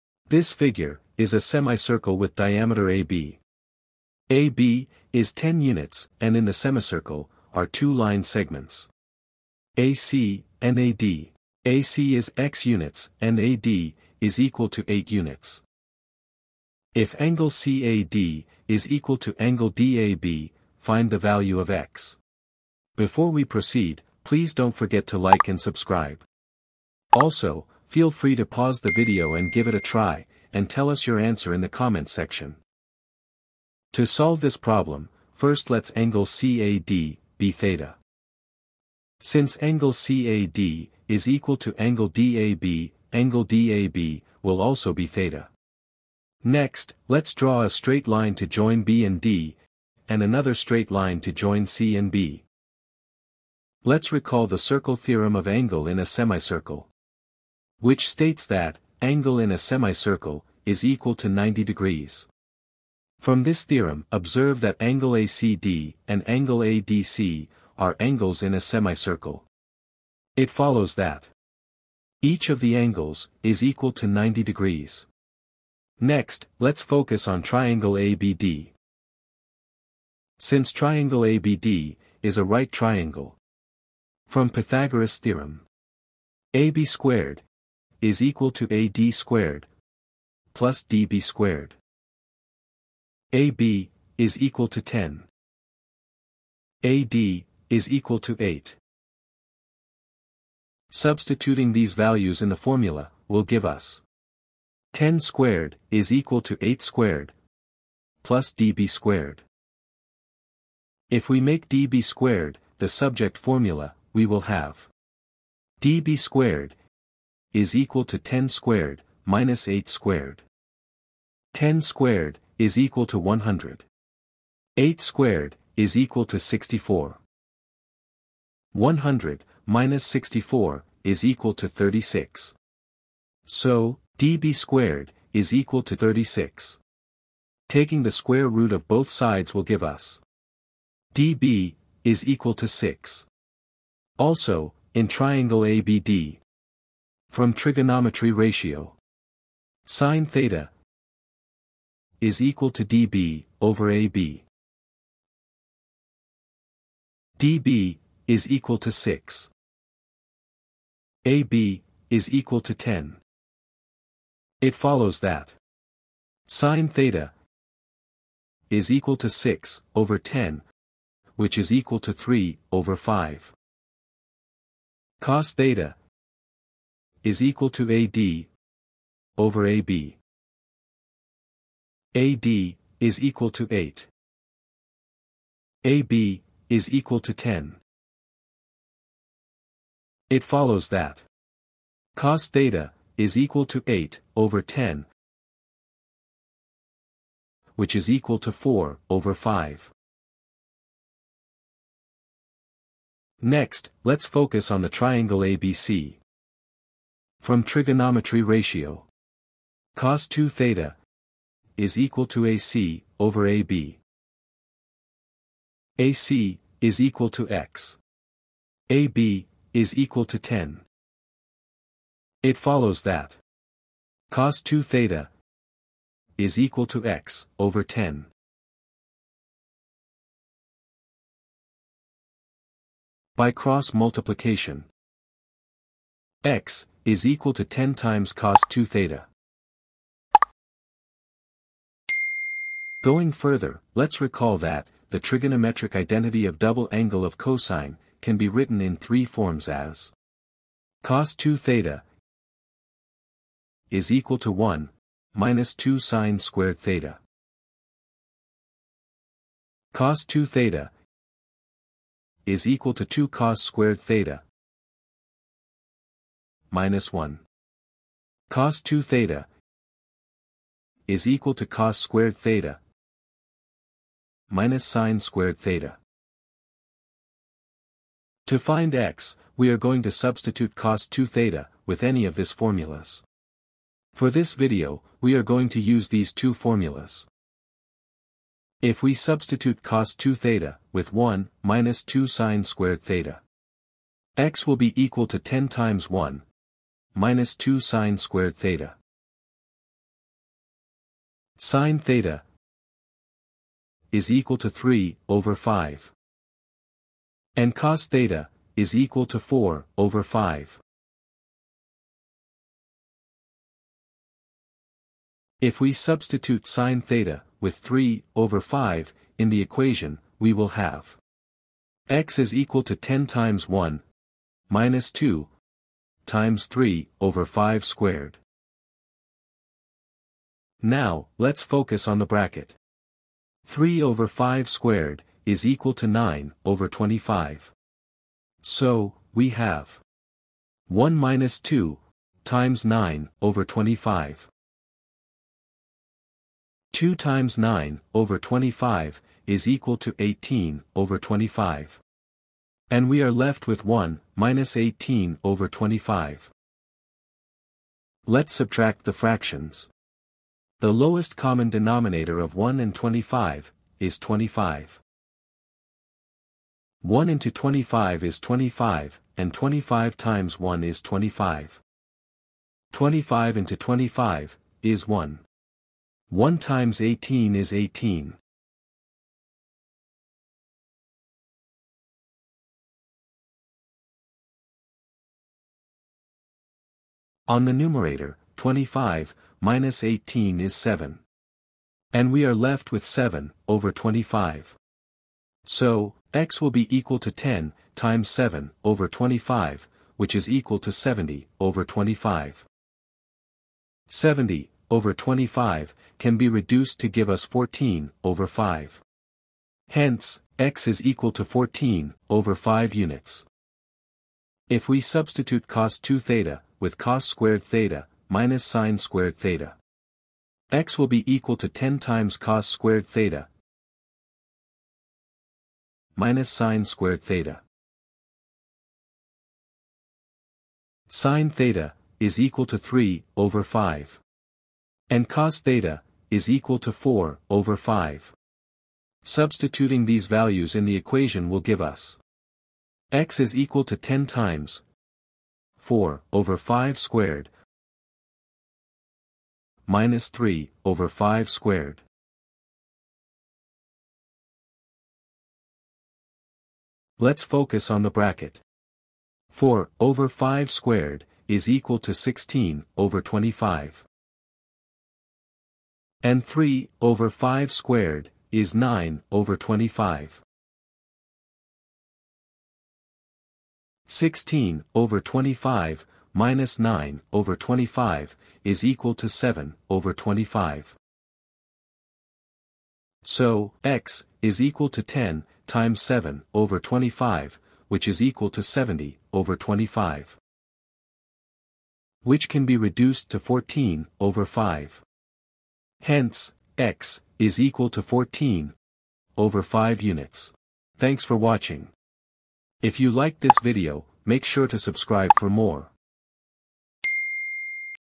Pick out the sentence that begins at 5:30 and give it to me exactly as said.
Now, let's focus on the bracket.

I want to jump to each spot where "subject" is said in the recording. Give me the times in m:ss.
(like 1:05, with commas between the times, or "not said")
1:52.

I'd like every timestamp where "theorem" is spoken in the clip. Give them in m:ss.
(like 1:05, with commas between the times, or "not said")
0:54, 1:03, 1:25.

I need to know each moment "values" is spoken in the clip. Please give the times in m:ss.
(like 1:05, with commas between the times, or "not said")
0:21, 1:41, 7:20.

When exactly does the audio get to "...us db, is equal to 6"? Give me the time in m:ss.
2:19.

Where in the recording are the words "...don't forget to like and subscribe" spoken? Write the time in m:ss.
0:24.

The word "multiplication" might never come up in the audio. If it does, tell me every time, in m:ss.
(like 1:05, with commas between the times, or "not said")
3:53.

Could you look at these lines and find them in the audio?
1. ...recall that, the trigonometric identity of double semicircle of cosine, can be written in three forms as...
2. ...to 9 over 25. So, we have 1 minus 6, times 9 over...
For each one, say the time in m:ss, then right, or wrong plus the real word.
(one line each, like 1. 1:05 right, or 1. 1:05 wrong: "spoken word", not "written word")
1. 4:04 wrong: "angle", not "semicircle"
2. 5:35 wrong: "2", not "6".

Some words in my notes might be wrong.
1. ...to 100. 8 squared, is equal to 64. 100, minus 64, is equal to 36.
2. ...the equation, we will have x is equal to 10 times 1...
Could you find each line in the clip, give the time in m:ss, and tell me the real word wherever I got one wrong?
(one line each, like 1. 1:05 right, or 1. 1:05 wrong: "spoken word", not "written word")
1. 2:03 right
2. 5:19 right.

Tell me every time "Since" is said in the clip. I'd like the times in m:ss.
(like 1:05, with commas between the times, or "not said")
0:39, 1:20.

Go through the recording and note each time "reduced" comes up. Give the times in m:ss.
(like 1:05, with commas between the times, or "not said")
6:46, 8:12.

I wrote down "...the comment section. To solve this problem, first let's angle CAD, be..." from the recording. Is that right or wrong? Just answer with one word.
right.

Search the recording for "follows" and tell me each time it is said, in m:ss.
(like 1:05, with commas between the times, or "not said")
1:10, 2:44, 3:10, 3:42.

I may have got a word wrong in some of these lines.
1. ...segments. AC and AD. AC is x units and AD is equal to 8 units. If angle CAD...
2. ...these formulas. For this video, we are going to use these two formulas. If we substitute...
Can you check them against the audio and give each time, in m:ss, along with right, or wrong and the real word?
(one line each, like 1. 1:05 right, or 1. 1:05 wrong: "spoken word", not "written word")
1. 0:08 right
2. 4:42 right.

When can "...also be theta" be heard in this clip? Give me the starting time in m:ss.
0:44.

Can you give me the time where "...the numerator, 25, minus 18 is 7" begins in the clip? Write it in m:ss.
6:27.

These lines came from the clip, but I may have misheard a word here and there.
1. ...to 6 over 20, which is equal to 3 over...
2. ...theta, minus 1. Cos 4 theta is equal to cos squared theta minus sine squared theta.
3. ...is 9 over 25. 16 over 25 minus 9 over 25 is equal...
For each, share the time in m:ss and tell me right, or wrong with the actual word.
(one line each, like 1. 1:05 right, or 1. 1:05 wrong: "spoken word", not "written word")
1. 2:49 wrong: "10", not "20"
2. 4:24 wrong: "2", not "4"
3. 7:48 right.